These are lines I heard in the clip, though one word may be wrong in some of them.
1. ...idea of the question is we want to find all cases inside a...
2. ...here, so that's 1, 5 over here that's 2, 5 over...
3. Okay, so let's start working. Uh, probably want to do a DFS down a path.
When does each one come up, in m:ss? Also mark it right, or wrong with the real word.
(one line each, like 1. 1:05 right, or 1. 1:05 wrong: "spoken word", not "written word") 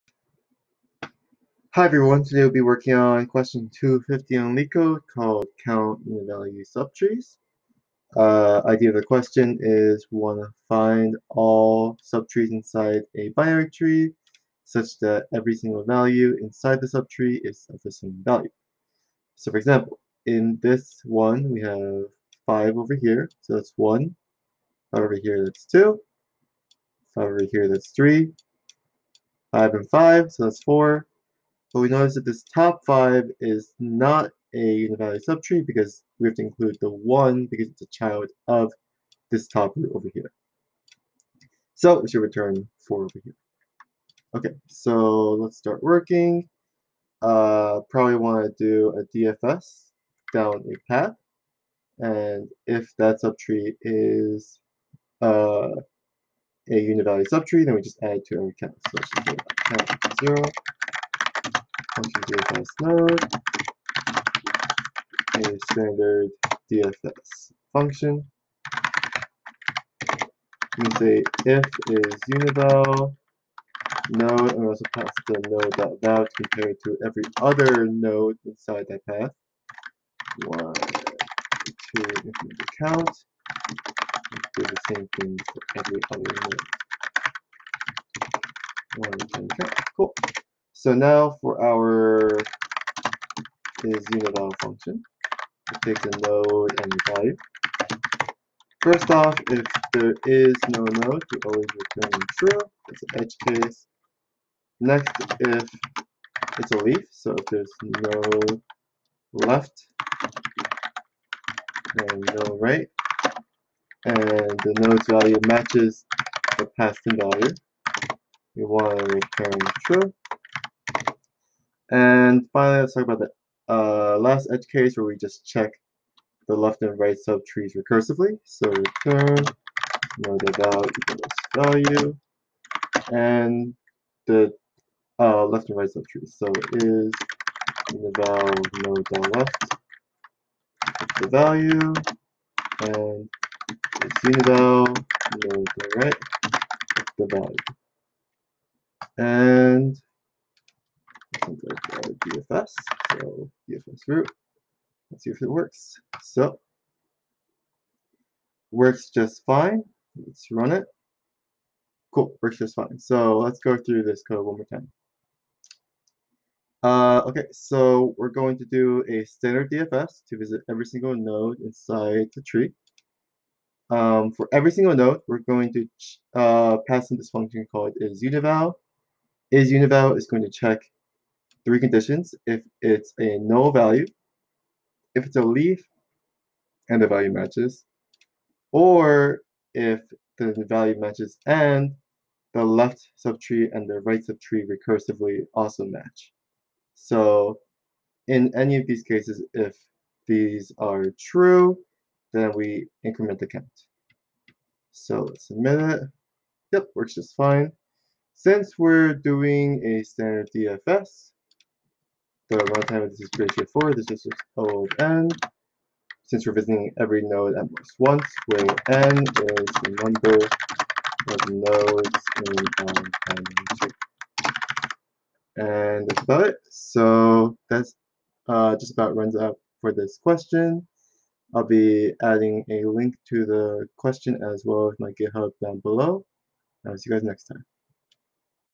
1. 0:08 wrong: "subtrees", not "cases"
2. 0:23 right
3. 0:44 right.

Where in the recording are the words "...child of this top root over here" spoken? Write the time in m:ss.
0:37.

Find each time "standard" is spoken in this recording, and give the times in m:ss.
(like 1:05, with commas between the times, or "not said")
1:05, 2:49, 3:30.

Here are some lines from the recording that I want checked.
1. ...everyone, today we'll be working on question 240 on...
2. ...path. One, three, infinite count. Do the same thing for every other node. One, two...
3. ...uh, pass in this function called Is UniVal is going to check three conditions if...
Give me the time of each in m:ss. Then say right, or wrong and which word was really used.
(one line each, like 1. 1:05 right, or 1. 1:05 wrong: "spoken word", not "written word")
1. 0:01 wrong: "250", not "240"
2. 1:19 wrong: "two", not "three"
3. 2:56 right.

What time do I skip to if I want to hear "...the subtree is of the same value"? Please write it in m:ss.
0:16.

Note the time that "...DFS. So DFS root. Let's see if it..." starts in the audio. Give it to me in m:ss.
2:32.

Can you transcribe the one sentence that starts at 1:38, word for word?
First off, if there is no node, we always return true.